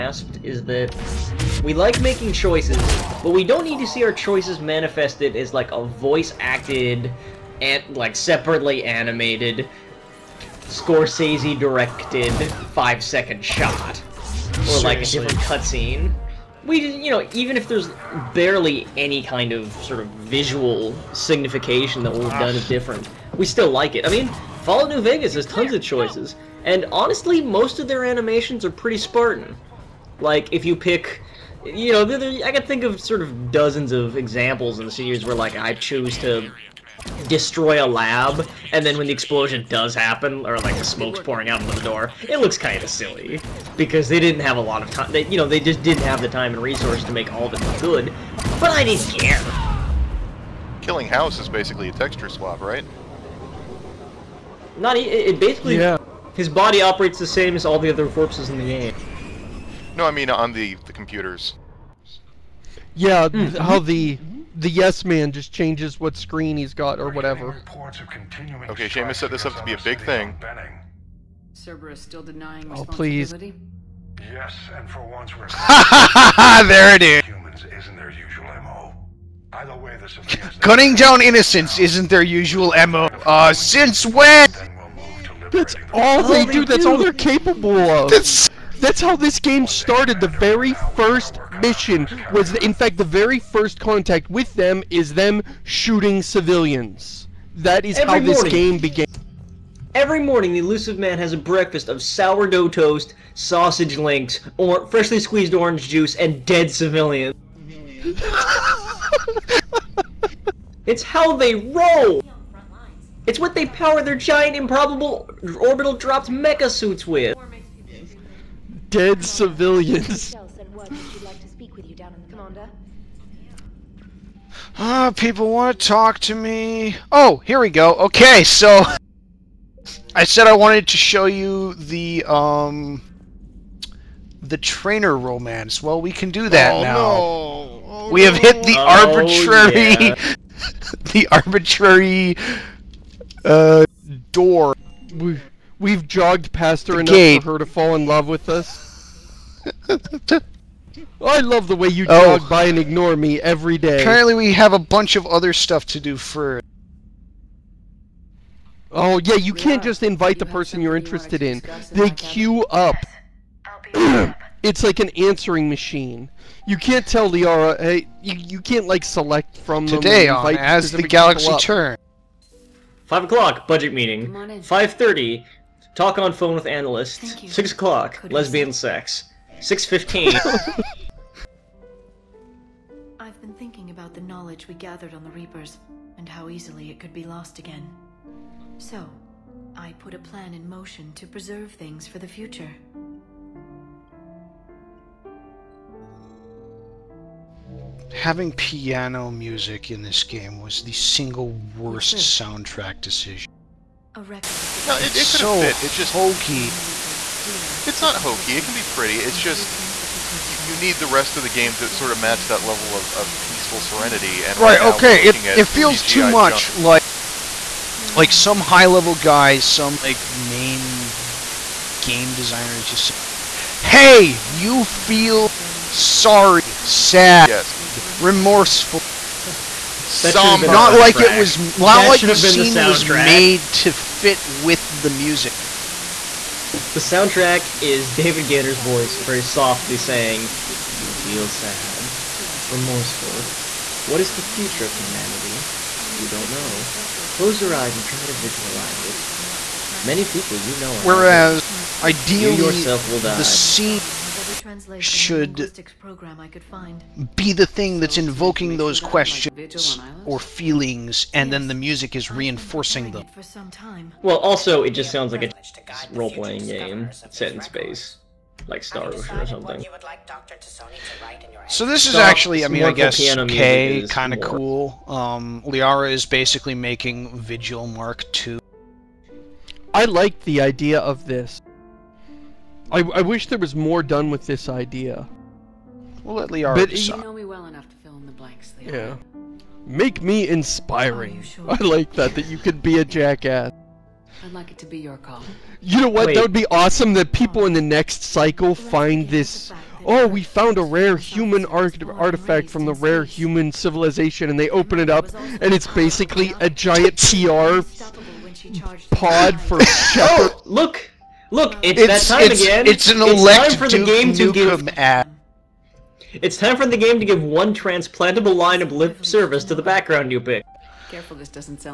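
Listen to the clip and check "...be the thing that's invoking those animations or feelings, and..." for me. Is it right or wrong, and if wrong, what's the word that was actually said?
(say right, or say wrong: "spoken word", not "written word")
wrong: "questions", not "animations".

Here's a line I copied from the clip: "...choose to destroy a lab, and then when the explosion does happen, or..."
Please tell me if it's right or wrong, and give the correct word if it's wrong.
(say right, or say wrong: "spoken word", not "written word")
right.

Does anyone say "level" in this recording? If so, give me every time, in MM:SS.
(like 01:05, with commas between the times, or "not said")
03:32, 03:38.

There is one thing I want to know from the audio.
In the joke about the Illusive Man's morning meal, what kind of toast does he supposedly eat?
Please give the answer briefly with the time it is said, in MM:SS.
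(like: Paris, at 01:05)
Sourdough, at 01:42.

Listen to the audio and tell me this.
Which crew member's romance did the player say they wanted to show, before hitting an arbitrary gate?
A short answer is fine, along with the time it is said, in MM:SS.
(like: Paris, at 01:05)
Traynor, at 02:14.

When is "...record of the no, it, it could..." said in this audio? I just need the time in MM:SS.
03:24.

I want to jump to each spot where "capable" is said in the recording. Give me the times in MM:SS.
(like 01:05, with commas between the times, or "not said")
01:27.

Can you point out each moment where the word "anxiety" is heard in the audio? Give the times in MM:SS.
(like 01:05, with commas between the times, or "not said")
not said.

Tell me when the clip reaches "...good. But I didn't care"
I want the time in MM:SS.
00:47.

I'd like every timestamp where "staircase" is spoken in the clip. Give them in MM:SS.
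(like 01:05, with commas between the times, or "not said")
not said.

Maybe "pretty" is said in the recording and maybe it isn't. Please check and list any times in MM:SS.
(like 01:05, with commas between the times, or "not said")
00:28, 03:28.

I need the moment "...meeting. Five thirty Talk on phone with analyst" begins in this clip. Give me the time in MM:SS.
02:53.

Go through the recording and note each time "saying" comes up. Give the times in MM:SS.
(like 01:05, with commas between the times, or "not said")
03:59.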